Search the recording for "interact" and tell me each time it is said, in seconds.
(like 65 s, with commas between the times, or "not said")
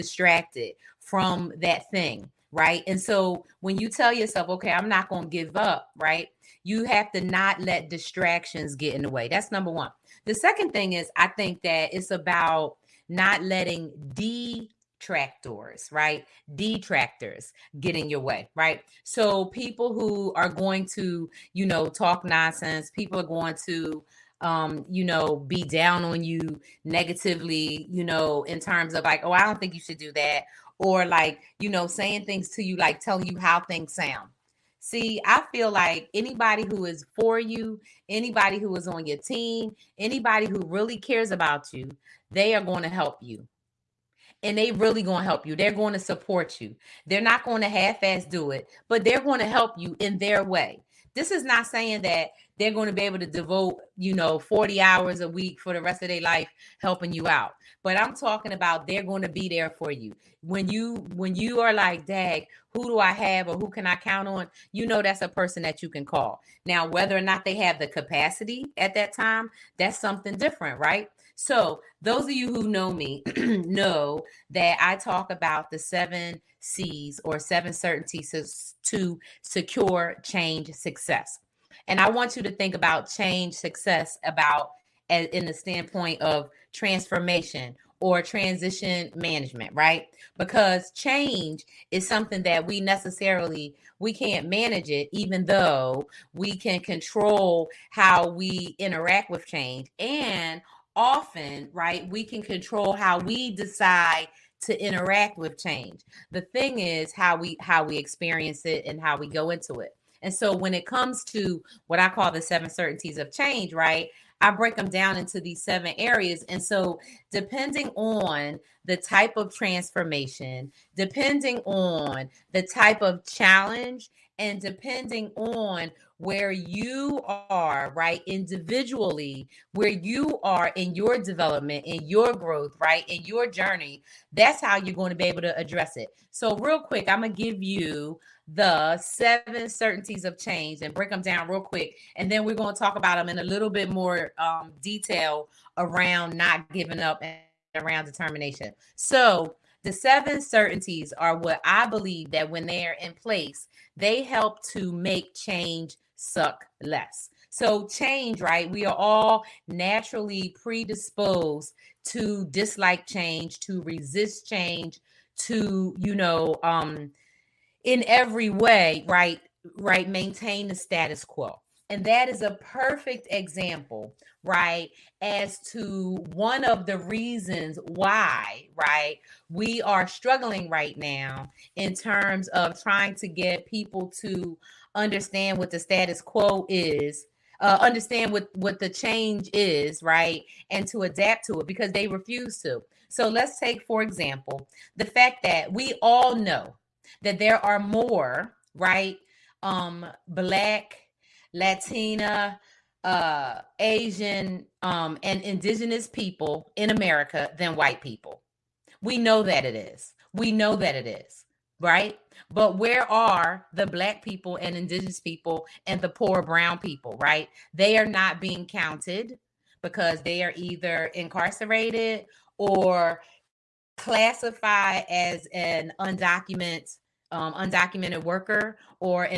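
98 s, 104 s.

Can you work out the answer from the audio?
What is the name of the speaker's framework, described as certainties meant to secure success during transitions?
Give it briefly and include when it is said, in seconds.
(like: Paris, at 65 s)
Seven C's, at 75 s.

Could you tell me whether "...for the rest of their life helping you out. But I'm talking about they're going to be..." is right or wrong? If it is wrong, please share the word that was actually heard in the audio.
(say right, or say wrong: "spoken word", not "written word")
right.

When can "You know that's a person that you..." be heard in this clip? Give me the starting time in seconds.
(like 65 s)
64 s.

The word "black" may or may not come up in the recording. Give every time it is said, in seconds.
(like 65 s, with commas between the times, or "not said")
200 s, 213 s.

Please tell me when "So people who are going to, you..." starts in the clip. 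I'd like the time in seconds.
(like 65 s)
19 s.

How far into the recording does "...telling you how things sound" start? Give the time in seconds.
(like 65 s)
33 s.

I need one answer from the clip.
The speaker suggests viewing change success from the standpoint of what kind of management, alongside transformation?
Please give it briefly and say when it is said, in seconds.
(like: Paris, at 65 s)
Transition management, at 88 s.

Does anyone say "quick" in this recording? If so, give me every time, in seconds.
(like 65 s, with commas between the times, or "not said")
136 s, 141 s.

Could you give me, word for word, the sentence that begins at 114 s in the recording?
I break them down into these seven areas.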